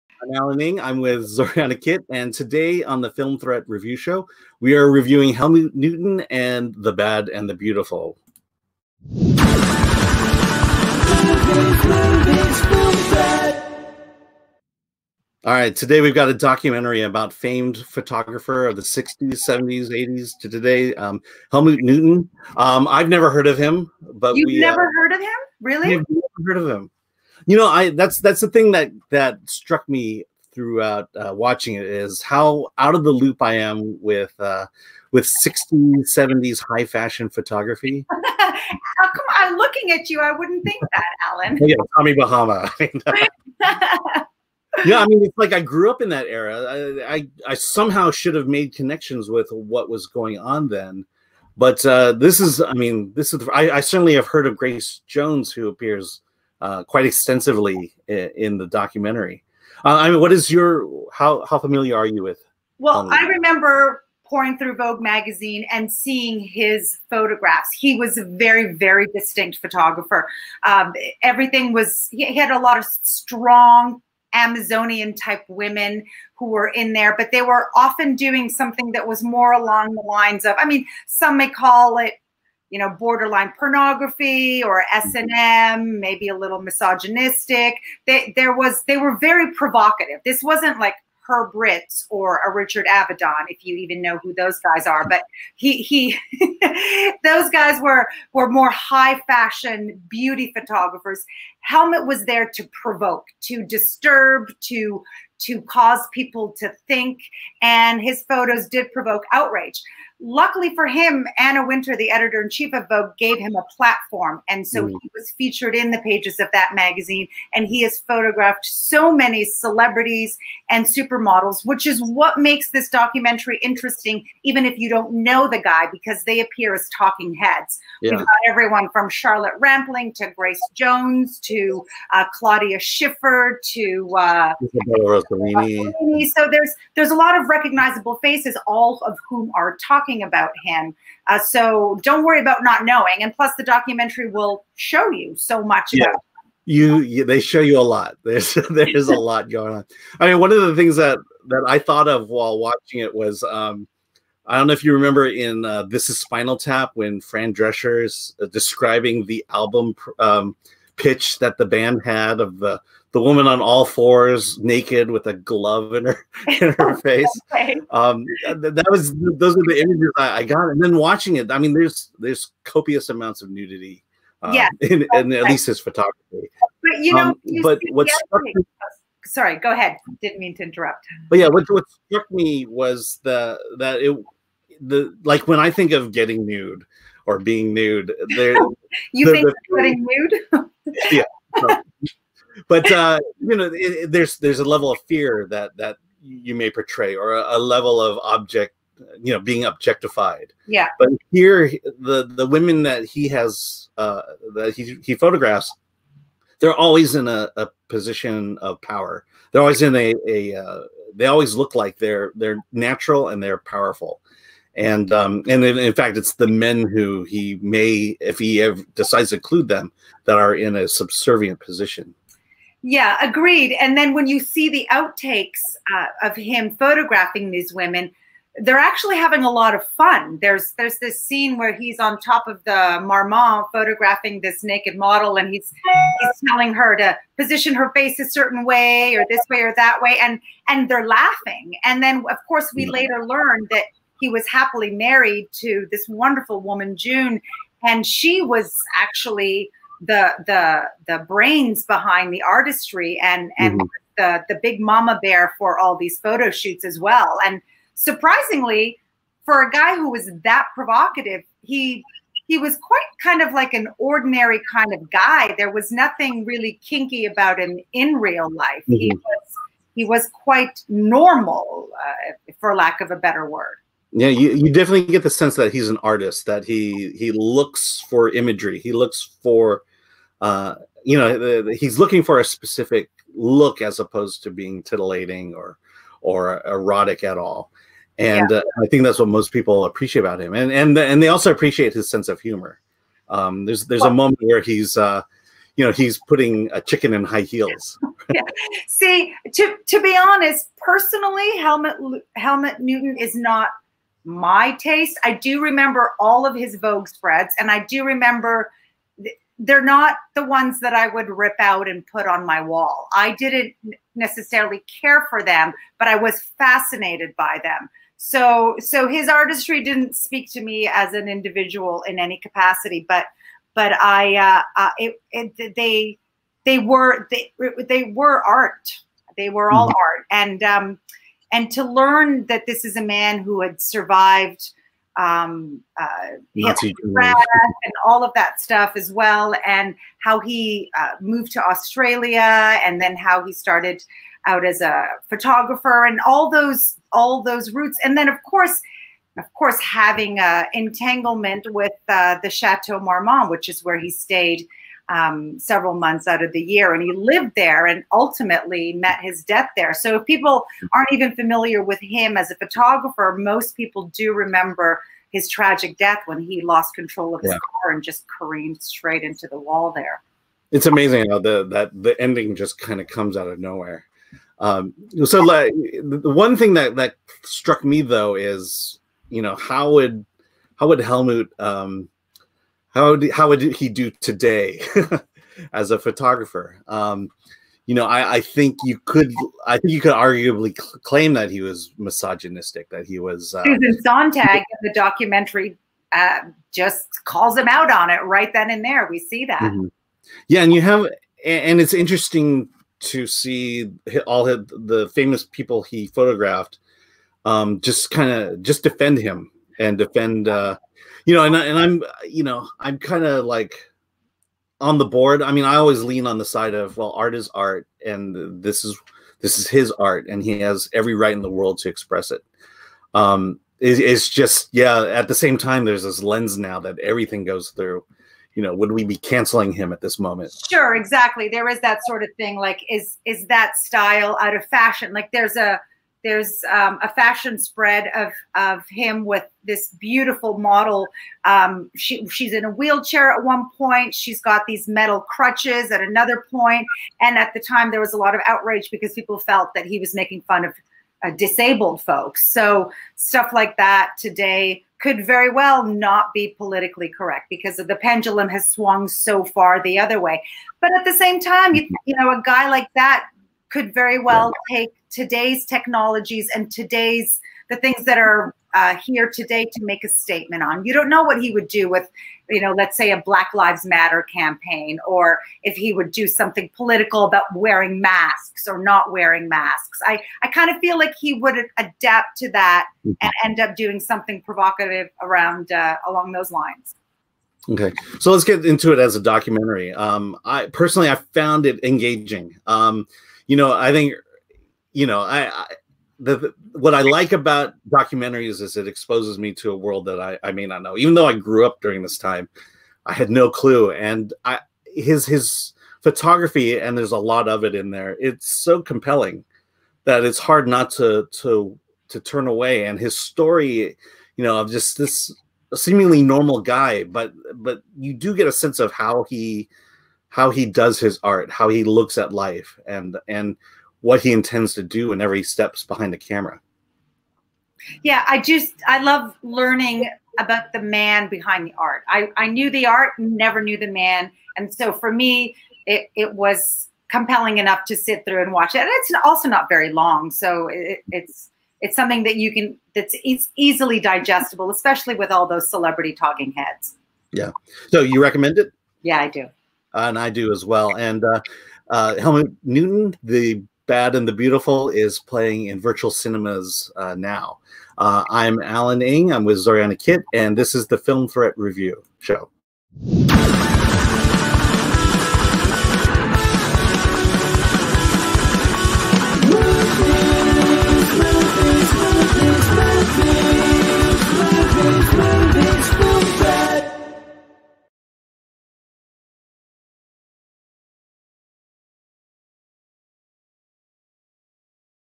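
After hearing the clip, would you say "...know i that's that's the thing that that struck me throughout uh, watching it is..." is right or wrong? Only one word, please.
right.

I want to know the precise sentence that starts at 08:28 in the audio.
It's so compelling that it's hard not to to to turn away.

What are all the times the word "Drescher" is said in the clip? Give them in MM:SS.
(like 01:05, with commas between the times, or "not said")
02:37.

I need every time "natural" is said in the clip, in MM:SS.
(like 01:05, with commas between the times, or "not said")
03:32.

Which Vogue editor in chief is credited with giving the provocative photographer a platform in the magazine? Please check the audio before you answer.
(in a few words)
Anna Wintour.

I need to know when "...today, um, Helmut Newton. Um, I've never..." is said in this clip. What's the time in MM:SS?
00:20.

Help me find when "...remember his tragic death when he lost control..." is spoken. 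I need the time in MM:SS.
06:04.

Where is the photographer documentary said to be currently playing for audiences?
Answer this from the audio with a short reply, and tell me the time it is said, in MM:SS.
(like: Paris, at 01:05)
Virtual cinemas, at 09:15.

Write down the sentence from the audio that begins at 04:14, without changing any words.
the the big mama bear for all these photo shoots as well.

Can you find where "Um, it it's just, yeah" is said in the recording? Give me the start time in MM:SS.
07:03.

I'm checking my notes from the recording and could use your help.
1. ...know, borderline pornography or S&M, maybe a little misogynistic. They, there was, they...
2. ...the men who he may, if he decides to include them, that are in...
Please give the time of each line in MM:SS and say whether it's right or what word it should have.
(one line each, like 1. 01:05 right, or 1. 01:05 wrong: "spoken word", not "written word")
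1. 01:22 right
2. 03:36 right.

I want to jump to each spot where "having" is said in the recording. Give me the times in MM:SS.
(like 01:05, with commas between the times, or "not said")
03:49, 05:49.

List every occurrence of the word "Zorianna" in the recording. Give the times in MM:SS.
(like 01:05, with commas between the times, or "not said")
00:01, 09:19.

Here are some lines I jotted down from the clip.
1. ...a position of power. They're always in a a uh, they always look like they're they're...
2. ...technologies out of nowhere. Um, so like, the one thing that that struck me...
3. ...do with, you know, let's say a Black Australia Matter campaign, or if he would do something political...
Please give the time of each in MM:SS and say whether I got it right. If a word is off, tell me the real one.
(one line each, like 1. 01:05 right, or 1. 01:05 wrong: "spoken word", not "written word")
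1. 03:27 right
2. 06:13 wrong: "comes", not "technologies"
3. 07:51 wrong: "Lives", not "Australia".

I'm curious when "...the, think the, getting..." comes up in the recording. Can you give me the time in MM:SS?
03:09.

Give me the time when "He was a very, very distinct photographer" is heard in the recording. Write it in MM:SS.
01:07.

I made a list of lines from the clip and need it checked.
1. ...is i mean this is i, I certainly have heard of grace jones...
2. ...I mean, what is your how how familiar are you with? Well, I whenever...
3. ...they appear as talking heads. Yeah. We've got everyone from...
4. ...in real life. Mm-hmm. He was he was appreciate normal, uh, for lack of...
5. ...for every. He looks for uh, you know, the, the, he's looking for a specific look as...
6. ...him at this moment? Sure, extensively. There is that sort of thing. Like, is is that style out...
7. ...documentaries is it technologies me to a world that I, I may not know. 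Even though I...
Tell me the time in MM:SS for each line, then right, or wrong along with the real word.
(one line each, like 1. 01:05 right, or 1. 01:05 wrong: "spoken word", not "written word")
1. 00:52 right
2. 00:59 wrong: "remember", not "whenever"
3. 02:06 right
4. 04:27 wrong: "quite", not "appreciate"
5. 04:38 wrong: "imagery", not "every"
6. 07:09 wrong: "exactly", not "extensively"
7. 08:17 wrong: "exposes", not "technologies".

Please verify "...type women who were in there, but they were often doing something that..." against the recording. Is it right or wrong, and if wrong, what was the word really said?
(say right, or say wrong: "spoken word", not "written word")
right.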